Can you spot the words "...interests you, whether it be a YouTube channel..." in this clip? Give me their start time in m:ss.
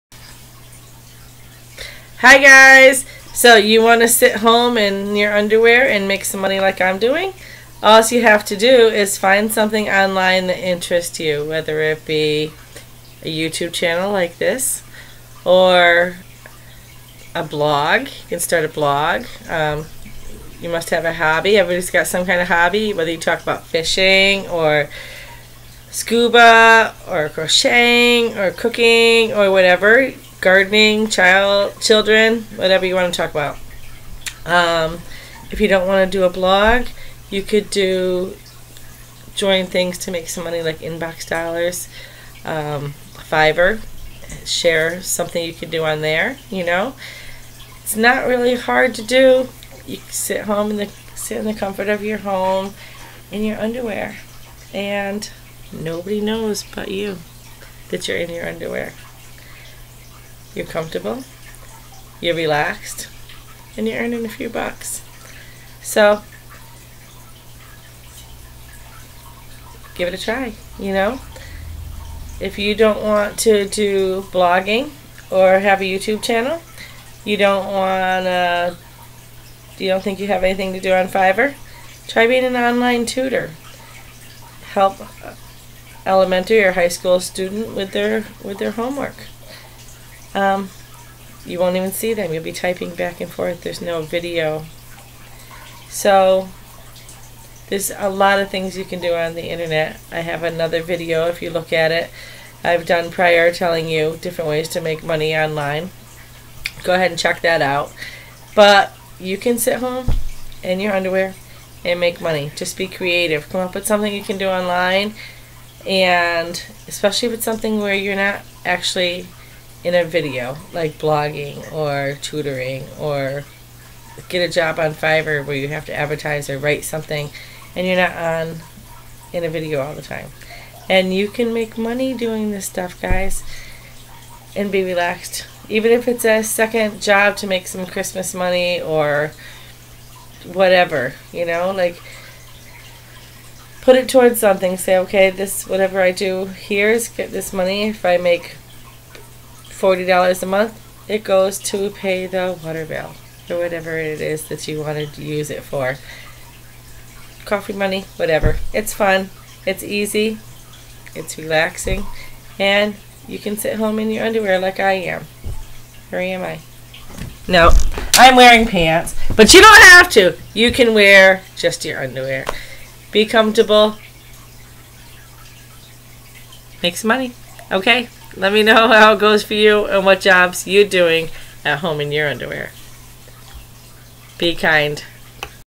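0:10.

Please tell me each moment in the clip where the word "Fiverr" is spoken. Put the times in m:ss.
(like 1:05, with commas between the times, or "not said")
0:43, 1:21, 2:04.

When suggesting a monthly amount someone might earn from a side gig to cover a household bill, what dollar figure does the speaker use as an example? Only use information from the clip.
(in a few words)
$40.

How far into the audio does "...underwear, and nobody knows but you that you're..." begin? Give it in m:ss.
0:53.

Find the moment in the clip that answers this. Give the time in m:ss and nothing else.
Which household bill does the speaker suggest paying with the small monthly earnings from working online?
2:32.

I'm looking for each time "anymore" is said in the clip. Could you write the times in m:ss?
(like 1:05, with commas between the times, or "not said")
not said.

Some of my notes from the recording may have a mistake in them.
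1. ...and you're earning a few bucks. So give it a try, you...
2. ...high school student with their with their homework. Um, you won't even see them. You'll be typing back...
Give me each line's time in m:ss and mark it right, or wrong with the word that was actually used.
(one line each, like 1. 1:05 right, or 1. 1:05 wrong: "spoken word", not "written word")
1. 1:03 right
2. 1:26 right.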